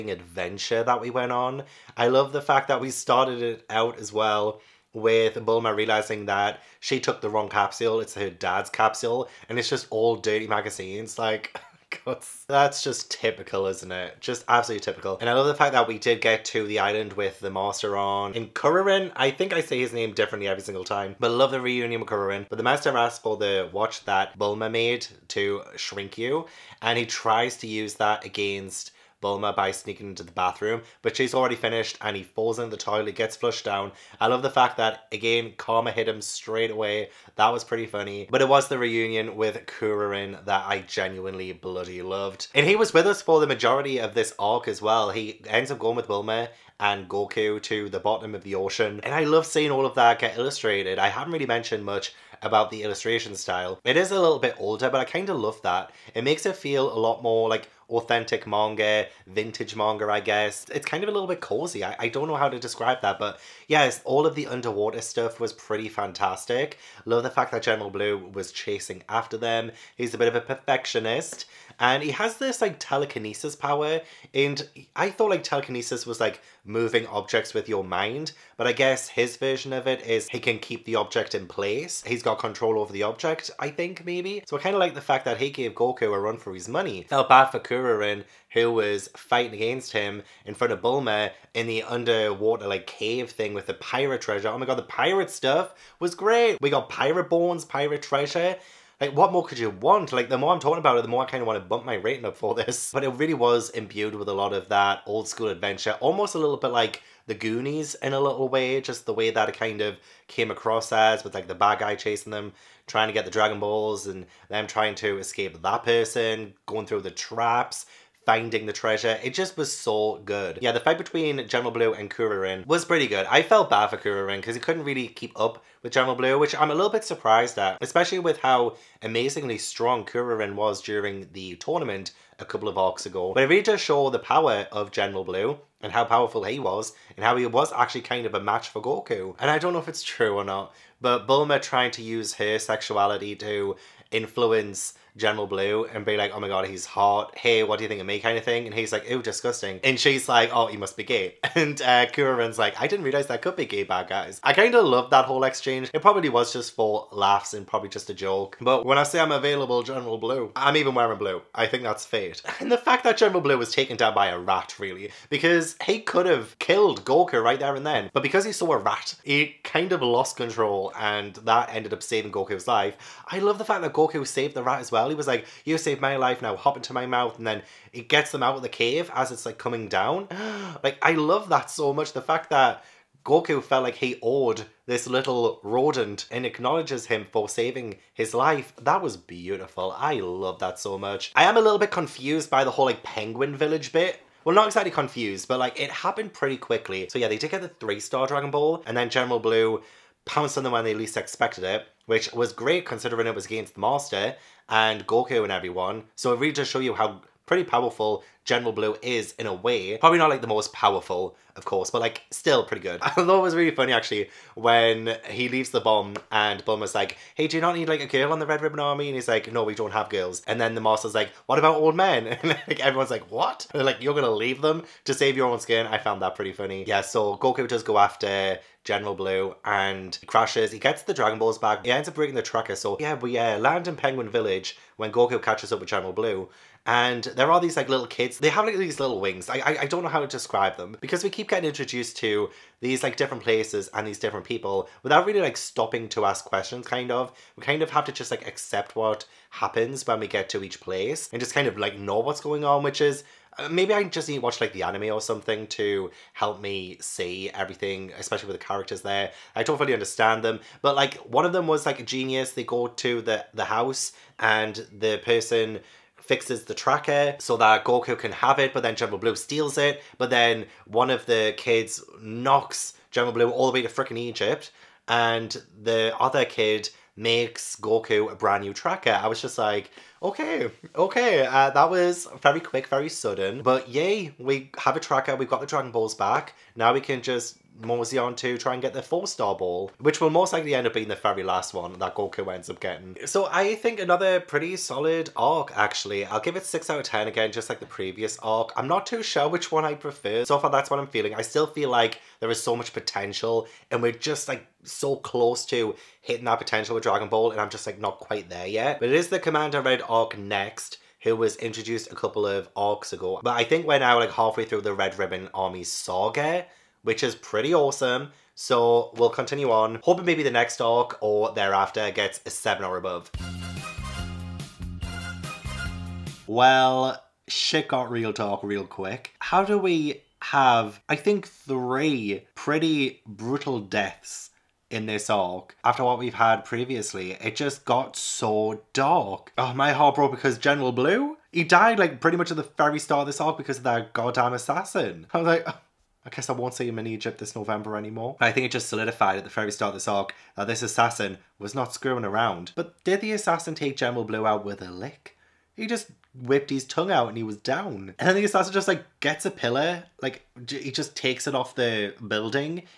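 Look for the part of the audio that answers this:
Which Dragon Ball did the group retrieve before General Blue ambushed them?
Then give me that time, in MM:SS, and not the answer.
03:17.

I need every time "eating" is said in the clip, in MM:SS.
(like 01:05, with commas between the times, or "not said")
not said.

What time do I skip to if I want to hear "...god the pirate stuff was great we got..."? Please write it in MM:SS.
01:34.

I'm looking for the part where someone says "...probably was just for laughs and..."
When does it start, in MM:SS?
02:36.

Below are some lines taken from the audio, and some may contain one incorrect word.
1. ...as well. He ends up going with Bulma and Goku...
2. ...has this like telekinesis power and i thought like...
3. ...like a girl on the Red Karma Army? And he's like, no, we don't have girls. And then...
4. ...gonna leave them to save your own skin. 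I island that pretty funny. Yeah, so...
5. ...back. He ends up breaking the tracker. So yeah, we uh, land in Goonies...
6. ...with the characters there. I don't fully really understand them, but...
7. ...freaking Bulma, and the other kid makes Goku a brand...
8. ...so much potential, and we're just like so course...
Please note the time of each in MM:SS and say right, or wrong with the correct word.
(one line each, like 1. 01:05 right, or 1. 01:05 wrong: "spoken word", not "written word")
1. 00:44 right
2. 01:12 right
3. 03:37 wrong: "Ribbon", not "Karma"
4. 03:44 wrong: "found", not "island"
5. 03:51 wrong: "Penguin", not "Goonies"
6. 04:18 right
7. 04:33 wrong: "Egypt", not "Bulma"
8. 05:02 wrong: "close", not "course".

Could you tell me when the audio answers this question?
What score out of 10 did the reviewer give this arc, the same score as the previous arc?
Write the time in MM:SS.
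04:56.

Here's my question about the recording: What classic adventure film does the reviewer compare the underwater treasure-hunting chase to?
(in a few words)
The Goonies.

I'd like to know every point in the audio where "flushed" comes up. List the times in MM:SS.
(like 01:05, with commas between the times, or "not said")
00:33.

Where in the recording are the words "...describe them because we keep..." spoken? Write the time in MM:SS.
04:00.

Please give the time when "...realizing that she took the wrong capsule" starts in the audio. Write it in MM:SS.
00:05.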